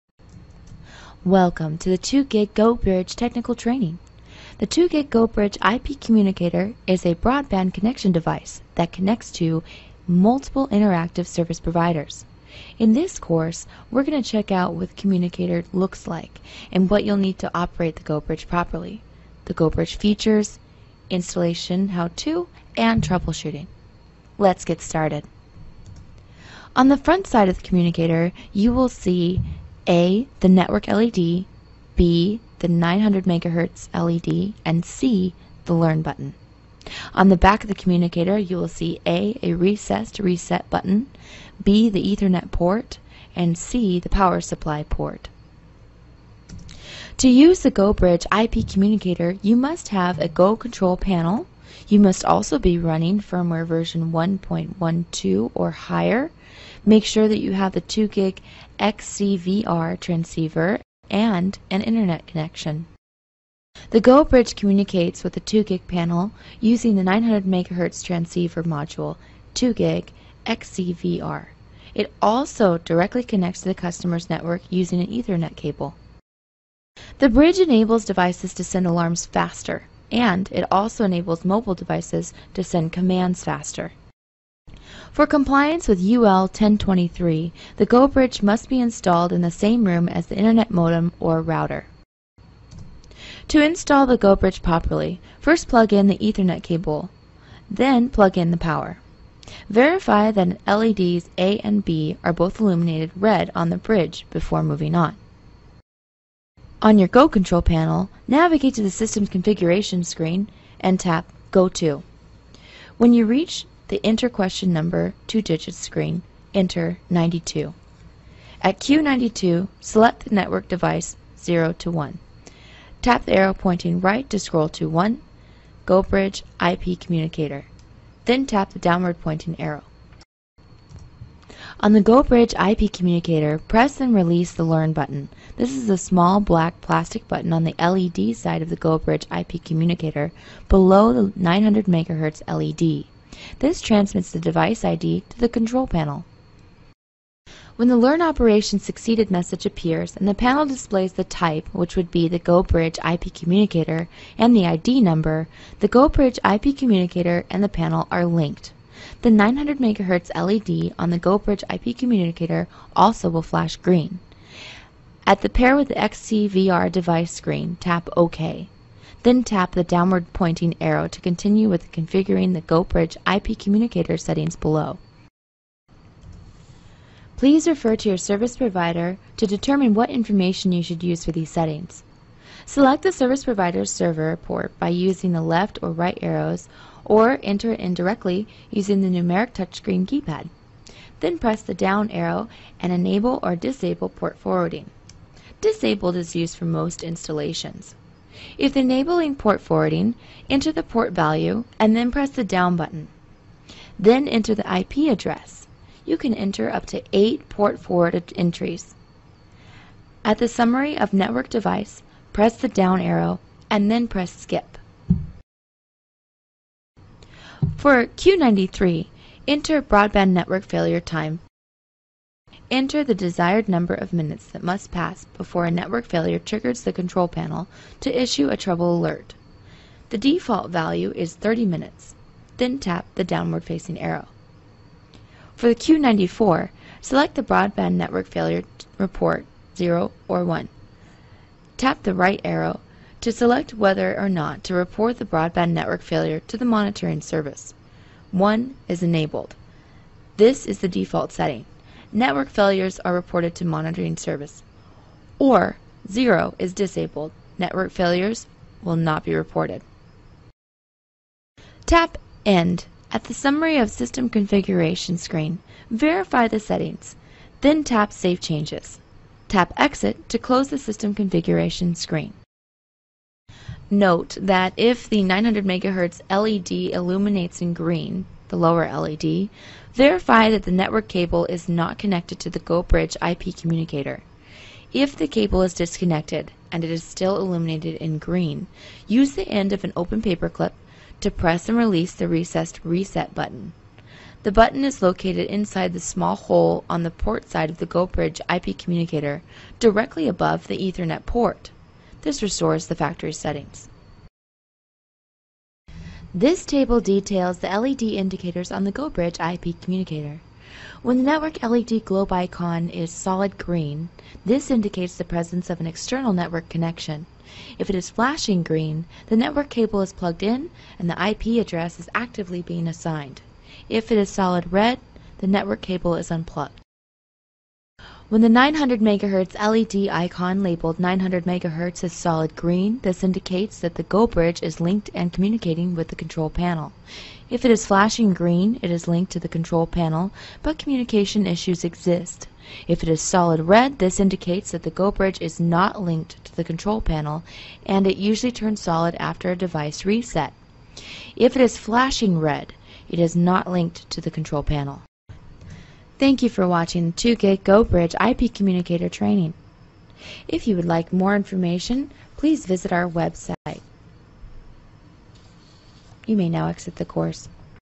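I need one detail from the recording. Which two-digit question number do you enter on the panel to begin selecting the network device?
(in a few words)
92.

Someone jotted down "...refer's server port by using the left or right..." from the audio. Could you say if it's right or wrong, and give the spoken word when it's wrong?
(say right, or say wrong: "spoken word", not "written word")
wrong: "provider", not "refer".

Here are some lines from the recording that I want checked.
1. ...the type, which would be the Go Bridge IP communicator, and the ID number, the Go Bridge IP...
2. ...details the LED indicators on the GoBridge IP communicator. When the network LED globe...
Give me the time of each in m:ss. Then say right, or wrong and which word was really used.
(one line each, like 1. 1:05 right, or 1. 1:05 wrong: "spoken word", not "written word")
1. 2:31 right
2. 5:07 right.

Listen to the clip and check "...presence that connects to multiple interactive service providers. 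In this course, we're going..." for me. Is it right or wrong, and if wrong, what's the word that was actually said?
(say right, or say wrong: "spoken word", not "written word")
wrong: "device", not "presence".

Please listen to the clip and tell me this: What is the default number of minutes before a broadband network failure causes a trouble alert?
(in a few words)
30 minutes.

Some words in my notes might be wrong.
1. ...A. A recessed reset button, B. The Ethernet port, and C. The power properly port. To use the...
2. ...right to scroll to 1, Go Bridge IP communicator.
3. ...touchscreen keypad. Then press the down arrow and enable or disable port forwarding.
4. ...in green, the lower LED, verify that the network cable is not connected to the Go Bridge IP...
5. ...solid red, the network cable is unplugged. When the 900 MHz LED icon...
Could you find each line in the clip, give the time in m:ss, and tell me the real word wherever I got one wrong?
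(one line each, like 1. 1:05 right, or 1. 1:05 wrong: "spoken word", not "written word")
1. 0:39 wrong: "supply", not "properly"
2. 2:03 right
3. 3:09 right
4. 4:37 right
5. 5:24 right.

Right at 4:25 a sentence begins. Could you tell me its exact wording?
Verify the settings, then tap Save Changes.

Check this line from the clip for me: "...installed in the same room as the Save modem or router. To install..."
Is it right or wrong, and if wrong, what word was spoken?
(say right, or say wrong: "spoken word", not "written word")
wrong: "Internet", not "Save".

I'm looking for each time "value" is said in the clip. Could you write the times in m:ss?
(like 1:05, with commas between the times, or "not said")
3:21, 3:50.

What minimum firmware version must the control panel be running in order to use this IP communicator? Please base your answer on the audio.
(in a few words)
1.12.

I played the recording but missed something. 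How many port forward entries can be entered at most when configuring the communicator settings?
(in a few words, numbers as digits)
8.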